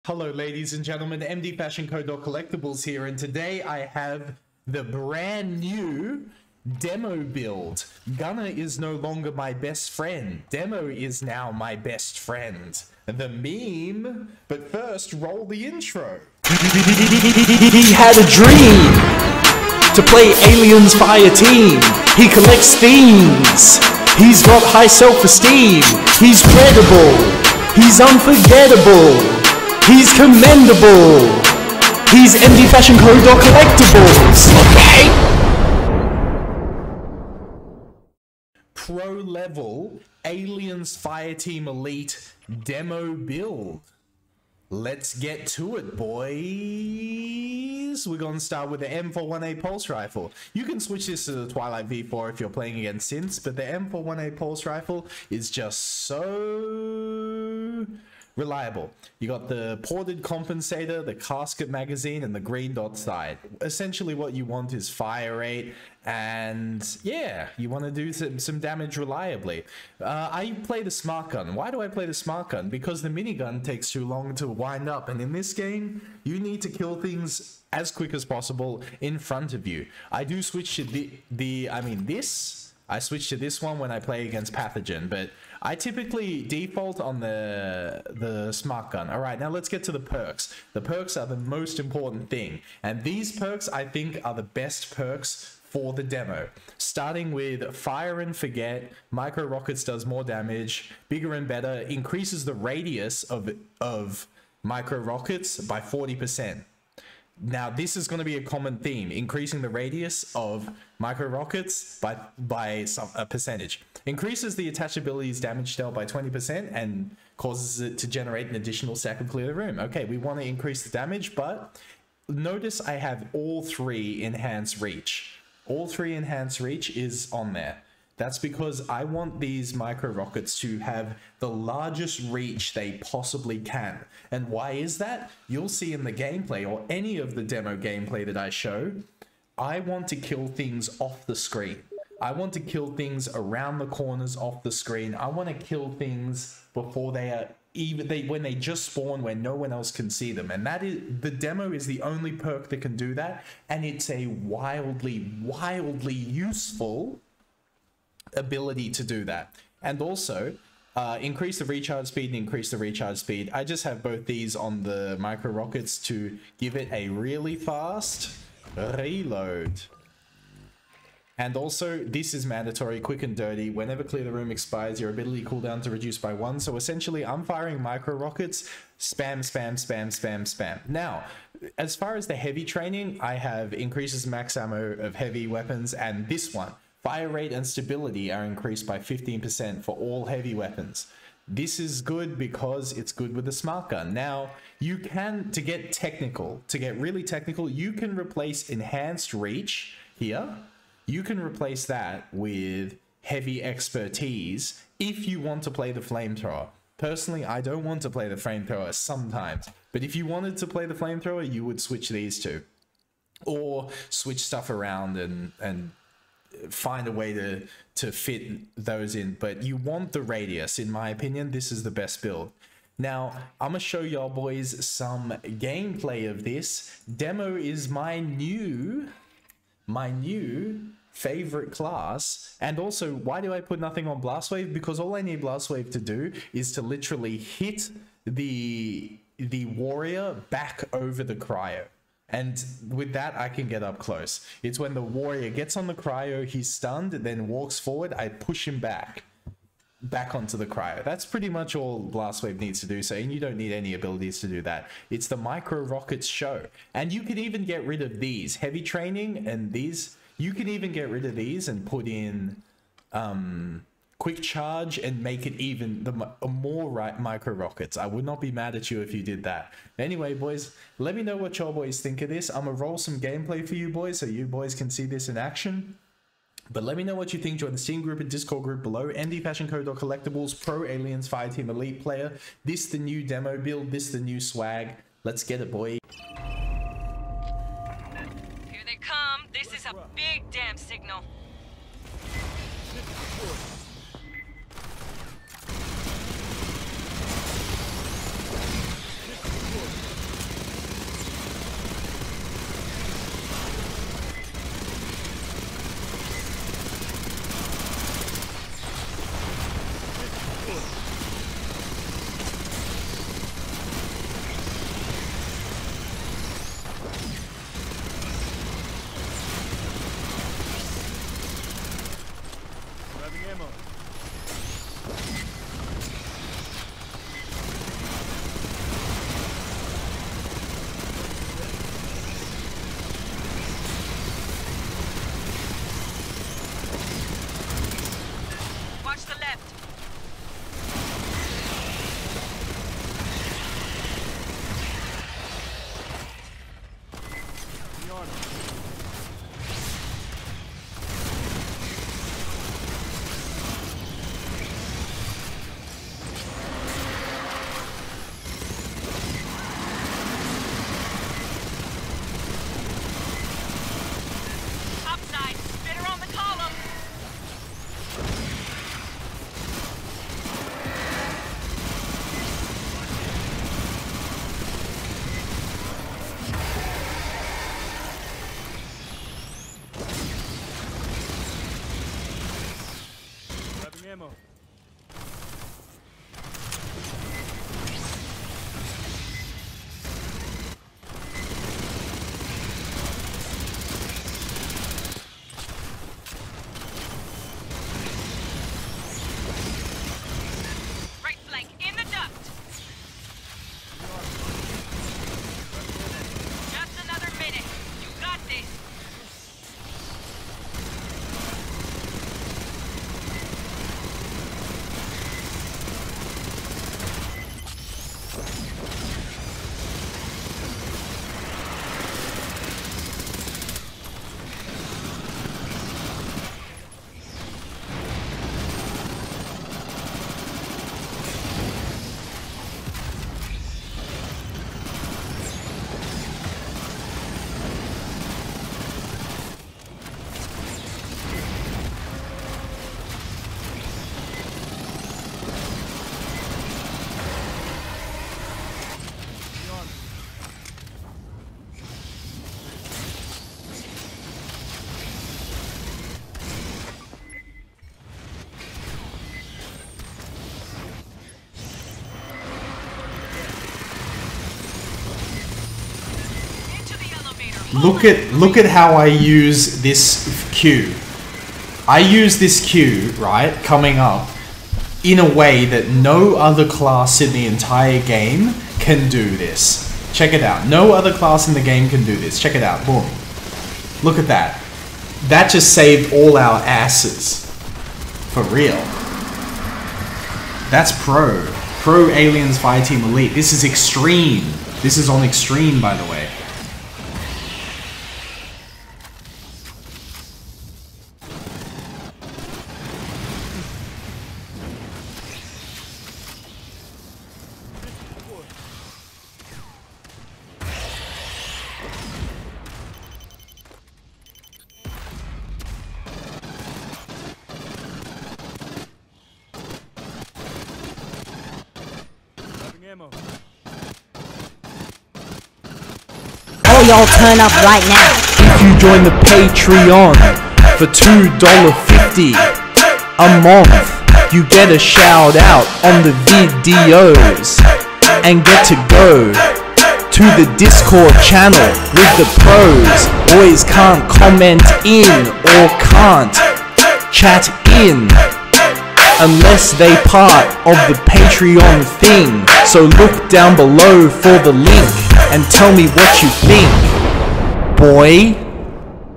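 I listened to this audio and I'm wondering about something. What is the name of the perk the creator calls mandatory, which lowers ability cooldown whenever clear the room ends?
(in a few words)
Quick and Dirty.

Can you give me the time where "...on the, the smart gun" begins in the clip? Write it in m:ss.
1:26.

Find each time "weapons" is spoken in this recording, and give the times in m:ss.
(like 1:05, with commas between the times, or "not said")
3:05, 3:10.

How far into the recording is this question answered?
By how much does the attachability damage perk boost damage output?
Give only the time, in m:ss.
1:56.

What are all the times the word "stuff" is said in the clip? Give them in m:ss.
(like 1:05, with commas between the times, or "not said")
3:34.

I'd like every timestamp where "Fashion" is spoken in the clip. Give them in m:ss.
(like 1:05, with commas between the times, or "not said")
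0:01, 0:32.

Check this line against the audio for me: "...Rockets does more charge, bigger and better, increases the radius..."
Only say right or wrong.
wrong.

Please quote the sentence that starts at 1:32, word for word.
And these perks, I think, are the best perks for the demo.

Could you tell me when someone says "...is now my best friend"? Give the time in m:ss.
0:10.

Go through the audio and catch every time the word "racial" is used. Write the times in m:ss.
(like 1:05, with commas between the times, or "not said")
not said.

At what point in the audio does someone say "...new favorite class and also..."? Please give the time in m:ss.
3:50.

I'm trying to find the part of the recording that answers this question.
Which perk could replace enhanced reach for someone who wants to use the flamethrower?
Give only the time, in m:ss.
3:23.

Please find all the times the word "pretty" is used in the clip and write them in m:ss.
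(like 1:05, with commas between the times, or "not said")
4:11.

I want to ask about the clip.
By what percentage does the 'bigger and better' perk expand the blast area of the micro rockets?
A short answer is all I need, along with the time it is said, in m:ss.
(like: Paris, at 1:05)
40%, at 1:45.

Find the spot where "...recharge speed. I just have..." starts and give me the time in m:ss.
2:42.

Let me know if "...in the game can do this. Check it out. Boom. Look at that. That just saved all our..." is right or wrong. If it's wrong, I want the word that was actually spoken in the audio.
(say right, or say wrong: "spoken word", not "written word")
right.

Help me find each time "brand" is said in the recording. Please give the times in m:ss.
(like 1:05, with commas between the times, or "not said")
0:04.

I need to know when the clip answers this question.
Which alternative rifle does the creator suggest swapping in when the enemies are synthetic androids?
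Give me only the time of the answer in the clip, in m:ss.
0:51.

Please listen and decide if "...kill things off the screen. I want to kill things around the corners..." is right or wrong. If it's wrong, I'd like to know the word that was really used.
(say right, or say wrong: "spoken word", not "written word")
right.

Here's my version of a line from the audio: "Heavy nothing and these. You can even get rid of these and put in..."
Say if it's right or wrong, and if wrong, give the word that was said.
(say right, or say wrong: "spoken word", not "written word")
wrong: "training", not "nothing".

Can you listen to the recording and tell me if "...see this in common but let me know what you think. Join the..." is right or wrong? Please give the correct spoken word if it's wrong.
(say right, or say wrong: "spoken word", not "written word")
wrong: "action", not "common".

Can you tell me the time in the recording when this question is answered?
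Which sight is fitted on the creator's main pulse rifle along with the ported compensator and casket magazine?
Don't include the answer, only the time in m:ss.
1:02.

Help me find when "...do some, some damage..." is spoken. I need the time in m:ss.
1:07.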